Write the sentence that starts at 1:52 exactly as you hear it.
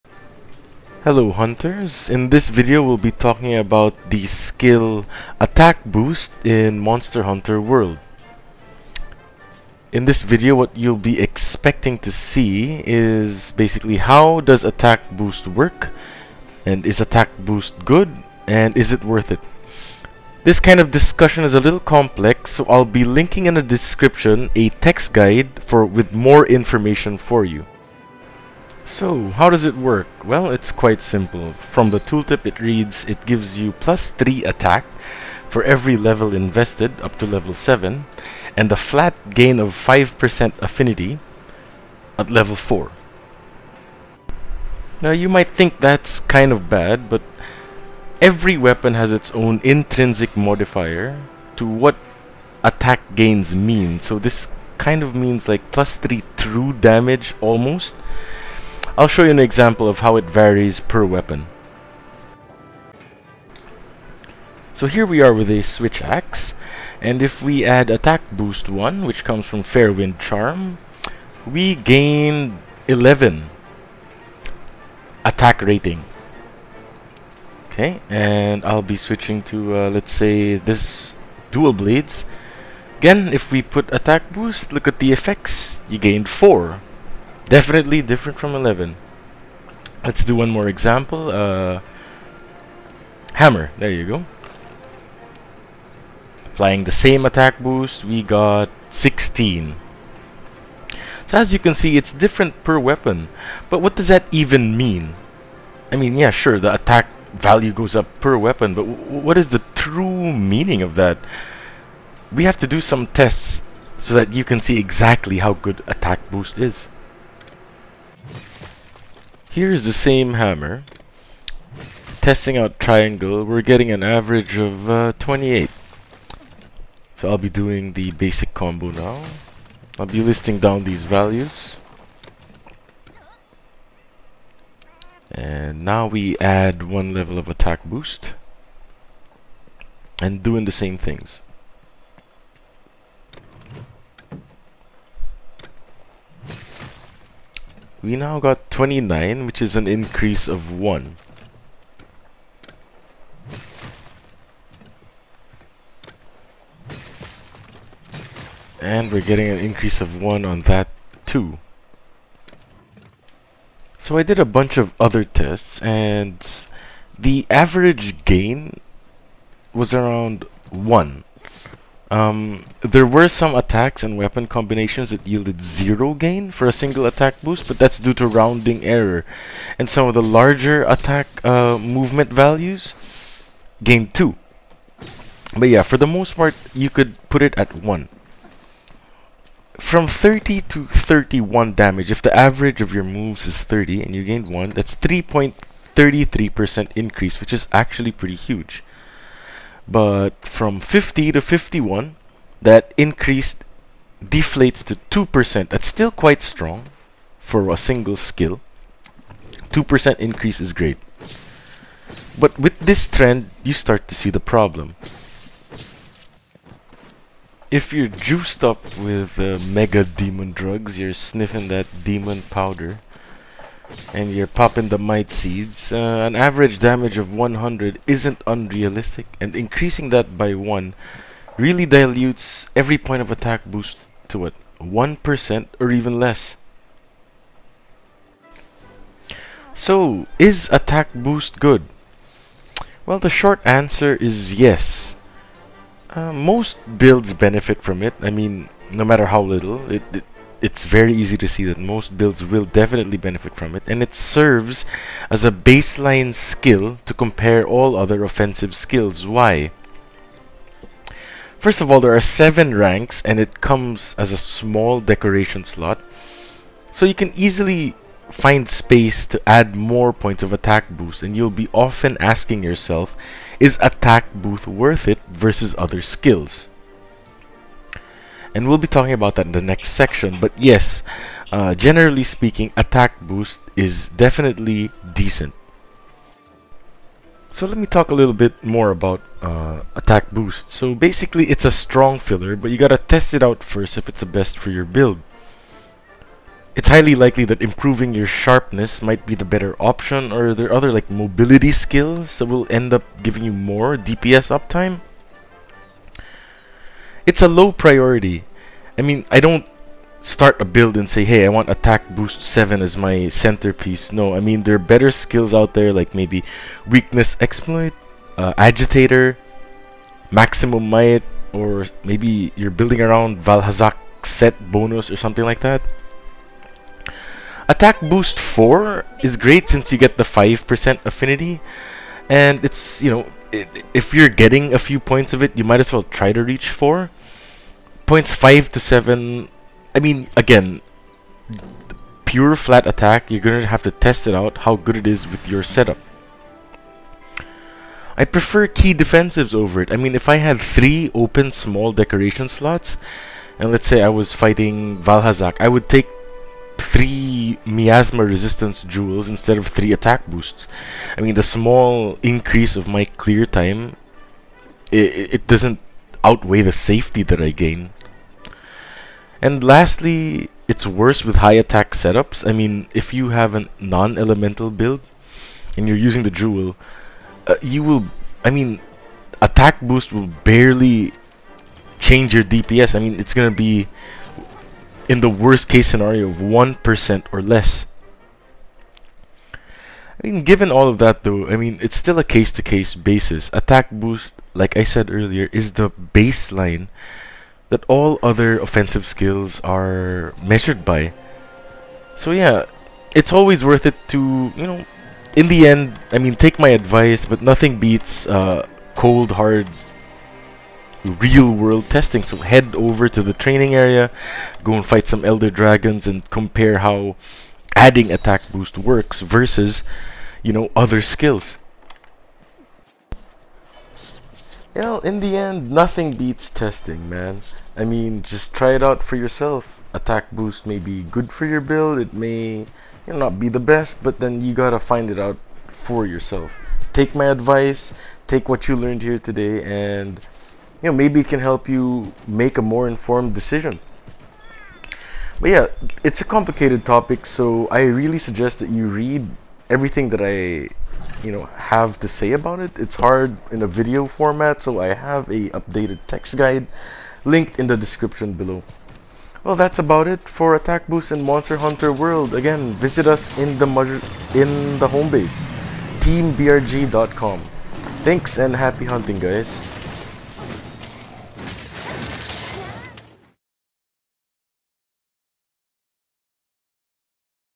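We have to do some tests so that you can see exactly how good attack boost is.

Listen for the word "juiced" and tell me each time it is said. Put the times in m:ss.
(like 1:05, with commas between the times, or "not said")
3:38.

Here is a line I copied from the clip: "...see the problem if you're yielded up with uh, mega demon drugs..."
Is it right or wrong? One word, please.
wrong.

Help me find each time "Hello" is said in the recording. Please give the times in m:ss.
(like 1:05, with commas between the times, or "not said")
0:01.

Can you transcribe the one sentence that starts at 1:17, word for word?
Okay, and I'll be switching to, uh, let's say, this dual blades.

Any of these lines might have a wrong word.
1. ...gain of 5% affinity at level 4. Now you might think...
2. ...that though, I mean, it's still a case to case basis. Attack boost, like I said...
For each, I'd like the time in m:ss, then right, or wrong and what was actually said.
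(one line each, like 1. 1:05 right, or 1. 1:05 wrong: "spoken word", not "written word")
1. 0:39 right
2. 6:31 right.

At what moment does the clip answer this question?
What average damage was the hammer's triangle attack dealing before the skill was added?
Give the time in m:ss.
2:04.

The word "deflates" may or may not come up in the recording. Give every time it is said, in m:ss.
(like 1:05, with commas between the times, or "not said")
3:24.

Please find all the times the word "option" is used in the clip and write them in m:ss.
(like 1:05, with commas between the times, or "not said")
4:59.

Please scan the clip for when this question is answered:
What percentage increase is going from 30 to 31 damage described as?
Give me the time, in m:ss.
3:14.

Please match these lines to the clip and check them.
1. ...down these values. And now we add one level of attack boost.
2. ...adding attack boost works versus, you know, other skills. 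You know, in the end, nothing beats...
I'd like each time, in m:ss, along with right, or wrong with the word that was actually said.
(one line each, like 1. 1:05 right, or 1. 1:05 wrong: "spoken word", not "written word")
1. 2:10 right
2. 6:57 right.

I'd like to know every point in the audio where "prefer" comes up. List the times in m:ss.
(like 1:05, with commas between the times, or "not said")
5:48.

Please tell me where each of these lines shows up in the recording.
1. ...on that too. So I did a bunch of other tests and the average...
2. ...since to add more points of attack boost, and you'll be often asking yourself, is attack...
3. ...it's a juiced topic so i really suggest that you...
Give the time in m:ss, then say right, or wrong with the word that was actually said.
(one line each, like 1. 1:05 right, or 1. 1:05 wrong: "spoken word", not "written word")
1. 2:40 right
2. 4:28 wrong: "space", not "since"
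3. 7:26 wrong: "complicated", not "juiced".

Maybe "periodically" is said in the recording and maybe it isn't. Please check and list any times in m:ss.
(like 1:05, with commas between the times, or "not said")
not said.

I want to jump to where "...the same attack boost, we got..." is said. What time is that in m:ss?
1:36.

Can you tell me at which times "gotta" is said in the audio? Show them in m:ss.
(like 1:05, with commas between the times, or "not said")
4:52, 7:14.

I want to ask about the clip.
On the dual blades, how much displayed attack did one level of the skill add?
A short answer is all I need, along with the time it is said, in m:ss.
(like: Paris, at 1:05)
4, at 1:25.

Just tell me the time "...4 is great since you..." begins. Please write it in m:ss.
5:28.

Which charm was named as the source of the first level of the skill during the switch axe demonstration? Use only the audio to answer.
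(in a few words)
Fairwind Charm.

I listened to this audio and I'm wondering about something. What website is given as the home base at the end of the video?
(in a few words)
teambrg.com.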